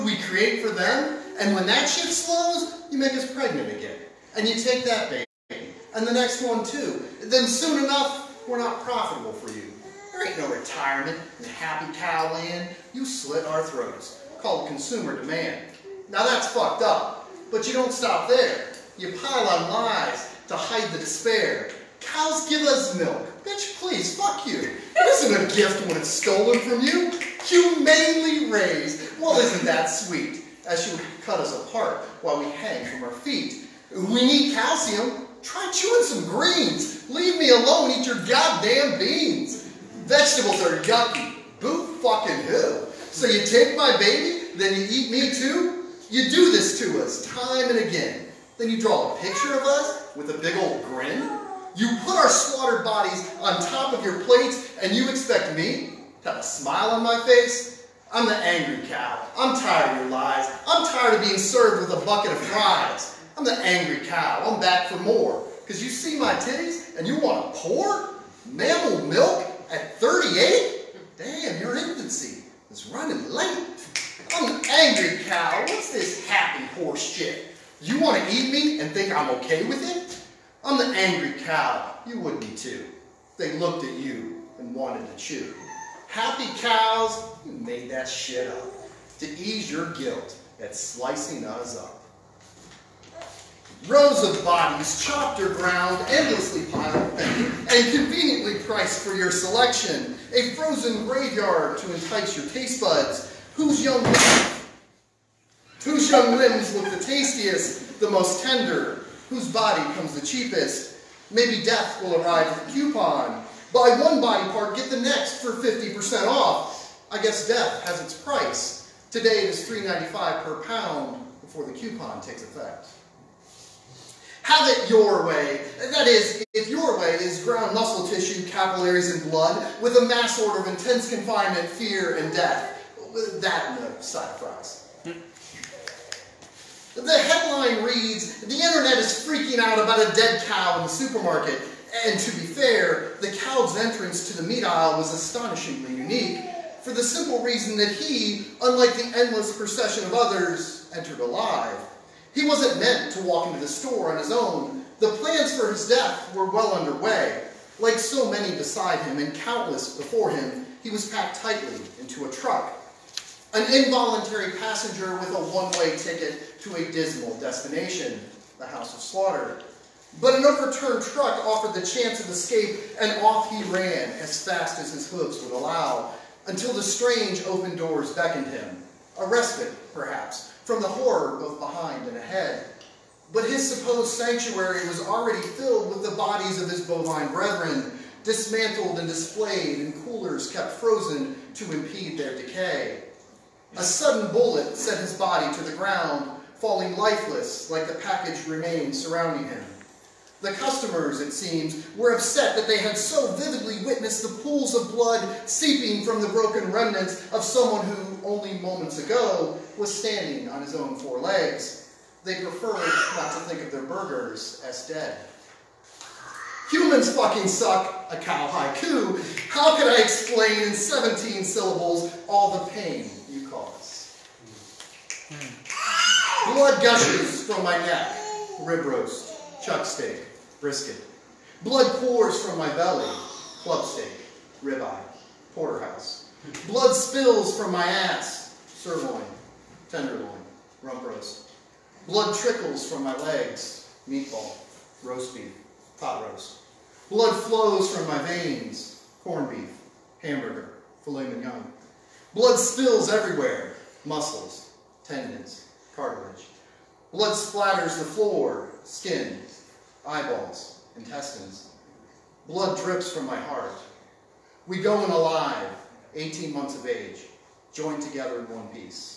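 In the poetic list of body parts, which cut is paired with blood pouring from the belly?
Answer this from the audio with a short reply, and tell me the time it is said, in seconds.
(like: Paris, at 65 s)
Club steak, at 233 s.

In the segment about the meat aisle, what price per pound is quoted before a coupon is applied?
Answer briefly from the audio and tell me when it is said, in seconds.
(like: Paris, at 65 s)
$3.95, at 119 s.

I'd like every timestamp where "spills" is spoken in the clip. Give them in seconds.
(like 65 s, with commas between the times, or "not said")
236 s, 252 s.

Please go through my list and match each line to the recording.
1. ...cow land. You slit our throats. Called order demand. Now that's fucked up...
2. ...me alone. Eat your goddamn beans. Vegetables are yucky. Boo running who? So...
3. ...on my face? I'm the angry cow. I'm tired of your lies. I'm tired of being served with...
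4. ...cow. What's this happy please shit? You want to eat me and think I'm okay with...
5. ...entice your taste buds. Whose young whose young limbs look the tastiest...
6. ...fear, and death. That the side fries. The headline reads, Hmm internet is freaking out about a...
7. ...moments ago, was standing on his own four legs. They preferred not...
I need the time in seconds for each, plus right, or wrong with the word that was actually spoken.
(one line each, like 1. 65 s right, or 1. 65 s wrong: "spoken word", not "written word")
1. 11 s wrong: "consumer", not "order"
2. 37 s wrong: "fucking", not "running"
3. 56 s right
4. 75 s wrong: "horse", not "please"
5. 101 s right
6. 131 s wrong: "The", not "Hmm"
7. 208 s right.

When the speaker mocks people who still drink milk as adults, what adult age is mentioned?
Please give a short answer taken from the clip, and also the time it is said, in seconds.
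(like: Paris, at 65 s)
38, at 70 s.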